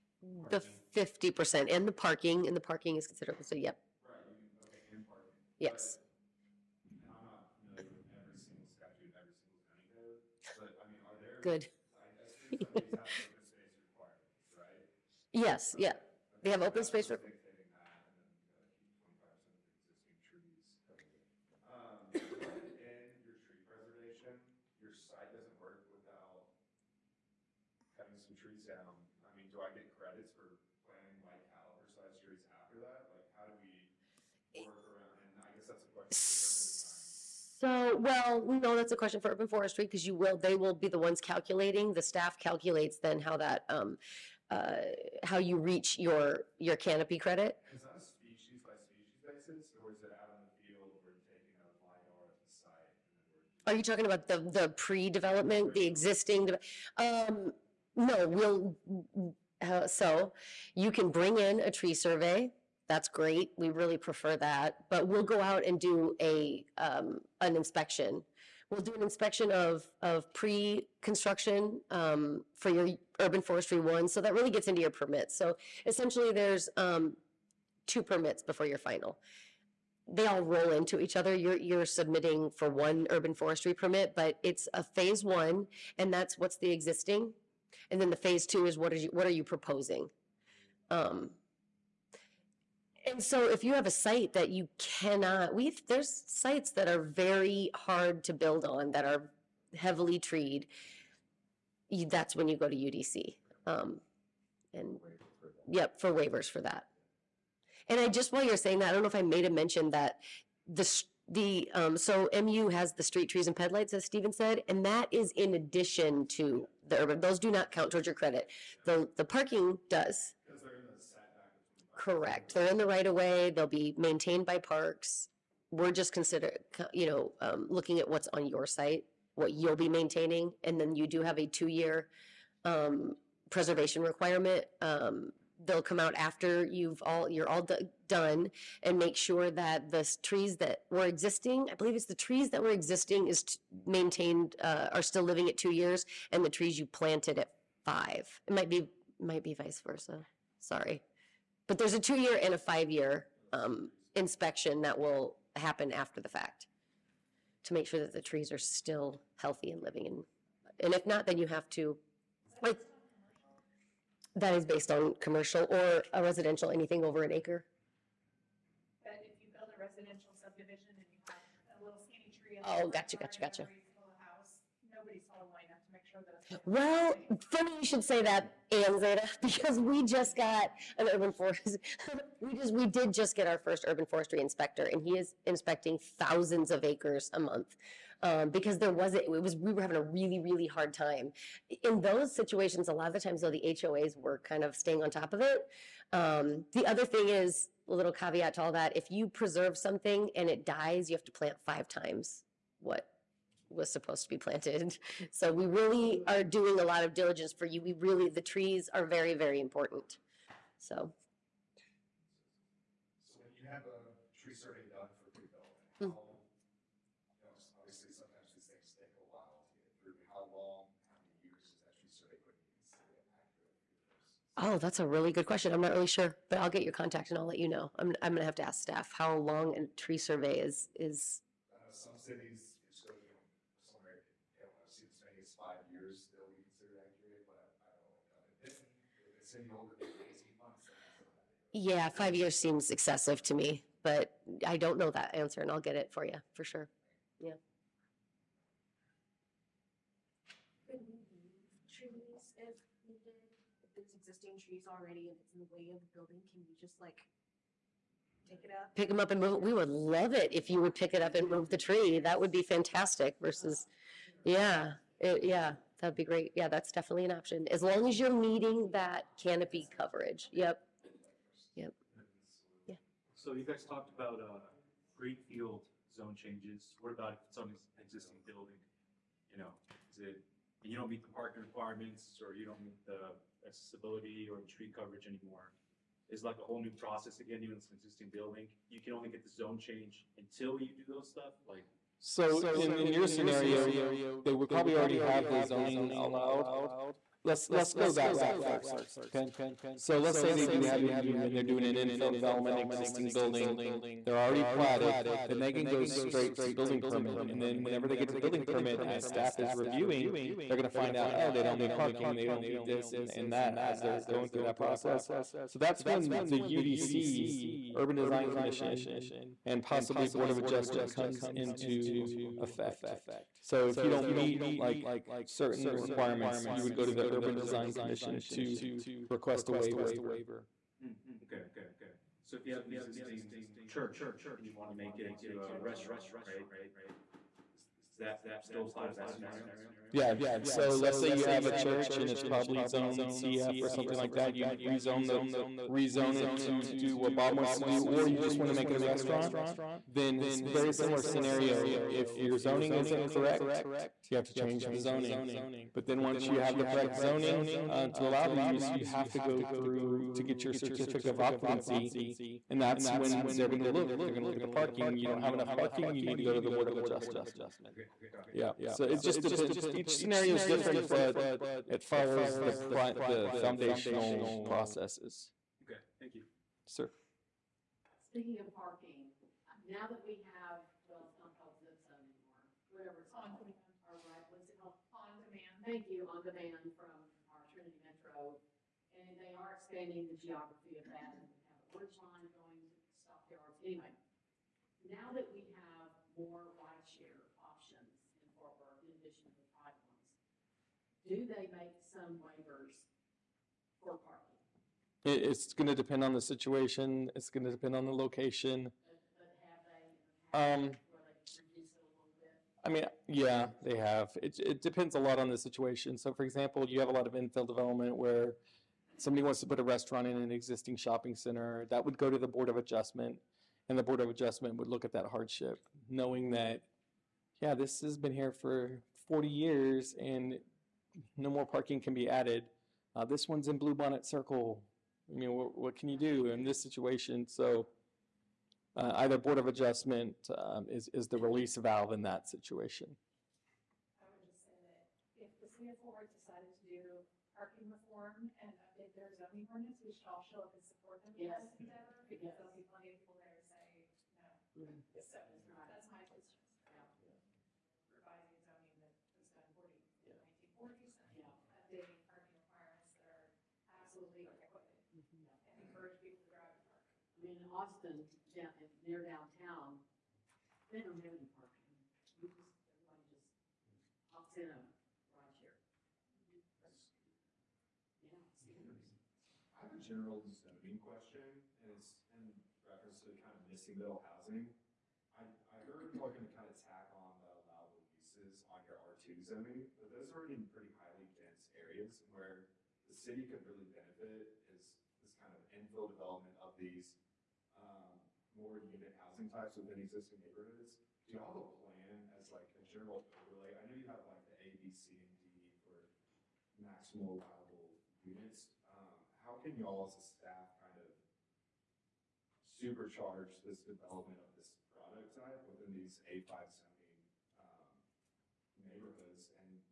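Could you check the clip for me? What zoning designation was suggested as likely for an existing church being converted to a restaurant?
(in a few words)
CF.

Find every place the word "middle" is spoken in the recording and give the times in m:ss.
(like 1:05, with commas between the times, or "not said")
8:03.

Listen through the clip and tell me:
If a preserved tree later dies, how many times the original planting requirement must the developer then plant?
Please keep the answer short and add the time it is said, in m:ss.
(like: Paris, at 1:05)
5 times, at 3:21.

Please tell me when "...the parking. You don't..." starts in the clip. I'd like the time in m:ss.
6:04.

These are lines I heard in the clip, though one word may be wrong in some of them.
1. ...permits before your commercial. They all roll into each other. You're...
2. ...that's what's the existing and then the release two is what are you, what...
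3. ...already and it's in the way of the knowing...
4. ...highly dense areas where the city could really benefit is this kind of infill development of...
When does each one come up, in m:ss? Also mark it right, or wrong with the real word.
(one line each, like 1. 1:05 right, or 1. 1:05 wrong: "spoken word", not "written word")
1. 1:18 wrong: "final", not "commercial"
2. 1:26 wrong: "phase", not "release"
3. 4:14 wrong: "building", not "knowing"
4. 8:10 right.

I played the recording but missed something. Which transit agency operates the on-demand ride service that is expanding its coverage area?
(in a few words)
Trinity Metro.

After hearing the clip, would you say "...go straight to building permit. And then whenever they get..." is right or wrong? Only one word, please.
right.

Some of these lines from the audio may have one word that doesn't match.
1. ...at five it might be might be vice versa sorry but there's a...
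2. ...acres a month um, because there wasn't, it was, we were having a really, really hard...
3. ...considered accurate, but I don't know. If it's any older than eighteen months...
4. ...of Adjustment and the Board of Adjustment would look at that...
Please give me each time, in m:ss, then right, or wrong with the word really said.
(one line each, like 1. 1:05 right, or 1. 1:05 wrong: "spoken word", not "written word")
1. 2:27 right
2. 3:06 right
3. 3:56 right
4. 7:02 right.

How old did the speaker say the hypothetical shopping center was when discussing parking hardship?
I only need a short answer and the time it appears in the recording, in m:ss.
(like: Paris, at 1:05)
40 years, at 7:09.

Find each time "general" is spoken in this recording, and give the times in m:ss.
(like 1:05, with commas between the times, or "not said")
7:59, 8:22.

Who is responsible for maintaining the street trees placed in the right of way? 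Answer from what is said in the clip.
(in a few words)
Parks.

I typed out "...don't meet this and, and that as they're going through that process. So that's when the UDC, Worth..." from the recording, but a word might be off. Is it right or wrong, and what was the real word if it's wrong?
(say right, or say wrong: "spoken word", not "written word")
wrong: "Urban", not "Worth".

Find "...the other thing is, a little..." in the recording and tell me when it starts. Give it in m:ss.
3:16.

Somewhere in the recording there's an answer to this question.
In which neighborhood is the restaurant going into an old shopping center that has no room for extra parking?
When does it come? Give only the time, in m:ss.
7:13.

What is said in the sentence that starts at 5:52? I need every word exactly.
If your zoning isn't correct, you have to change the zoning.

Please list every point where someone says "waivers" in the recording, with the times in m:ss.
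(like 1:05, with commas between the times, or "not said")
1:46, 5:29, 6:42.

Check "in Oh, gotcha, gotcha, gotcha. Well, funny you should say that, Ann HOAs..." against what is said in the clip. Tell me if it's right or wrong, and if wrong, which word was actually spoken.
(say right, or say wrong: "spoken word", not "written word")
wrong: "Zeta", not "HOAs".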